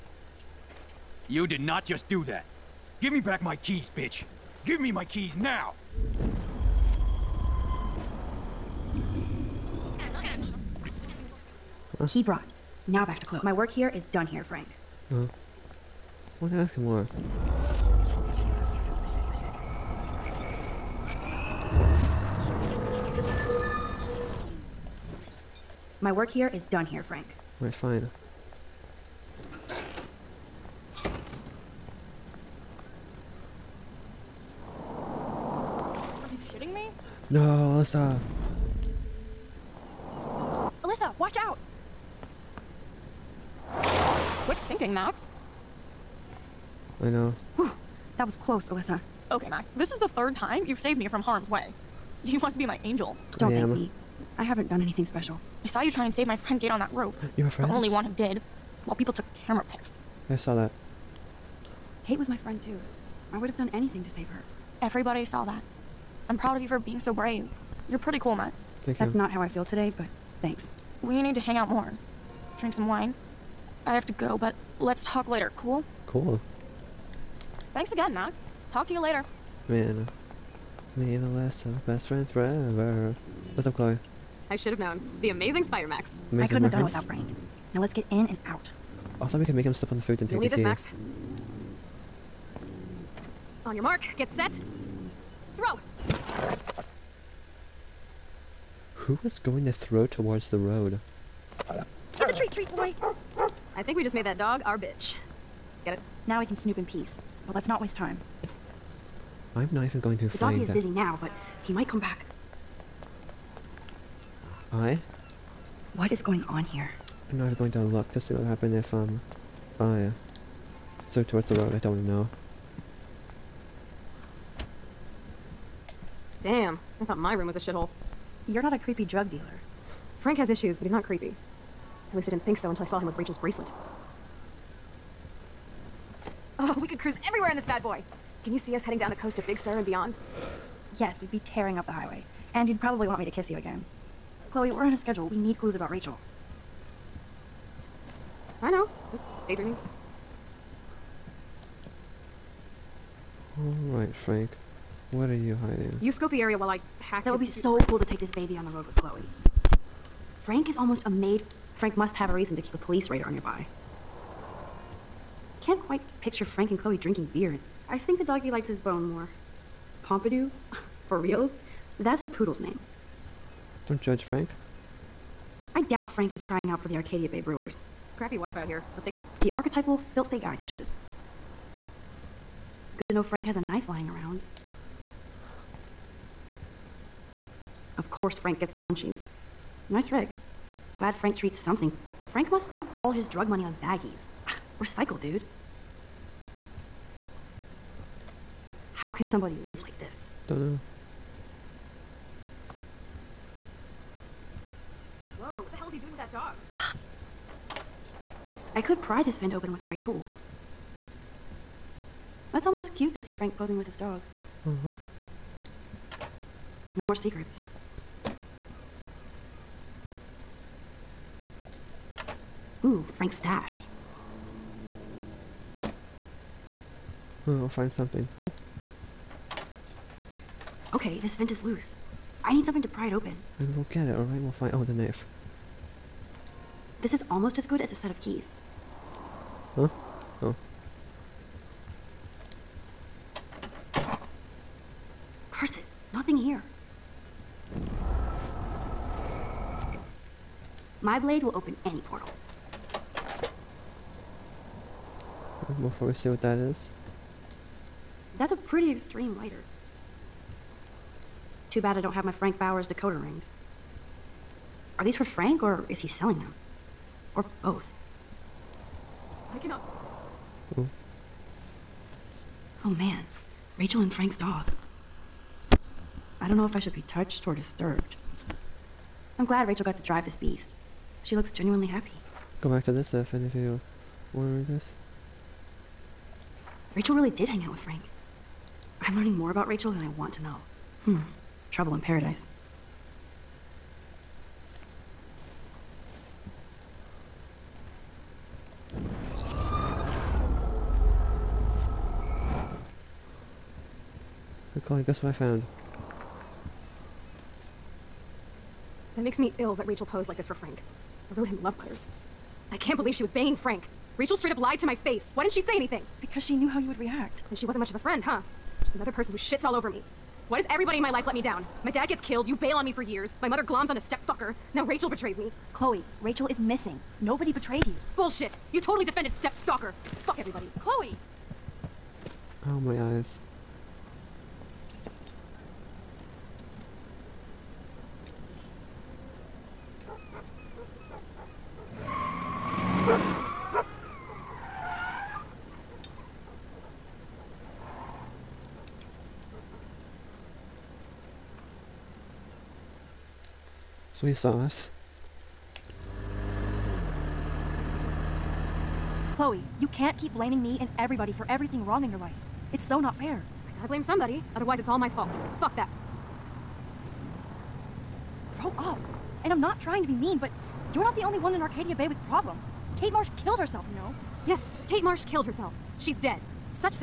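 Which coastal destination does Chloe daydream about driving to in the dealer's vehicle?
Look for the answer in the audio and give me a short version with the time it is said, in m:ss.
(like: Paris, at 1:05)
Big Sur, at 2:19.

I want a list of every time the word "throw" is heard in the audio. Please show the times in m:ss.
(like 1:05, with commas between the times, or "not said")
1:35, 1:39.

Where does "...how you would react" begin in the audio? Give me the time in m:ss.
5:16.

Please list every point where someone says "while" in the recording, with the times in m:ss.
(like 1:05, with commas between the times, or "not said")
0:58, 2:36.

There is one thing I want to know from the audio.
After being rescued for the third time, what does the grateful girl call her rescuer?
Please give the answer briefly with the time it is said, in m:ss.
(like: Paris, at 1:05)
My angel, at 0:52.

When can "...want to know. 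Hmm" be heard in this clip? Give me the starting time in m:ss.
4:50.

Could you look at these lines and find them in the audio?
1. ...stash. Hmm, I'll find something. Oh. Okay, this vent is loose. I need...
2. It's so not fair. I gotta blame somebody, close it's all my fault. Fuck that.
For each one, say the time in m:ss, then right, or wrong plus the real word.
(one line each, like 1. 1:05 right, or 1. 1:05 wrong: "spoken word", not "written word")
1. 3:43 right
2. 6:02 wrong: "otherwise", not "close".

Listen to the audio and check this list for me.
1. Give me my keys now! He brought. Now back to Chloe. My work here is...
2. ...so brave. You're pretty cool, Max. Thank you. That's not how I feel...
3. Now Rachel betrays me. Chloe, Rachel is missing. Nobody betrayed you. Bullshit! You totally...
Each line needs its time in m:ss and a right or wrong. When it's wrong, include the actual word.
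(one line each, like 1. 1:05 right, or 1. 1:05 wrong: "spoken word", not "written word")
1. 0:04 right
2. 1:06 right
3. 5:24 right.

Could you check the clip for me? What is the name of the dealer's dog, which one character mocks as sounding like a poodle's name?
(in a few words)
Pompidou.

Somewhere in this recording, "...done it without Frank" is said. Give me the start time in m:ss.
1:26.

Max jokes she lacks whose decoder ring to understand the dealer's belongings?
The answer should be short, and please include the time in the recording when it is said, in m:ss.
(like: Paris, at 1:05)
Frank Bowers, at 4:22.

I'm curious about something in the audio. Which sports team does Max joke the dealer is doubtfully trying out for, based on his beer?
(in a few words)
Arcadia Bay Brewers.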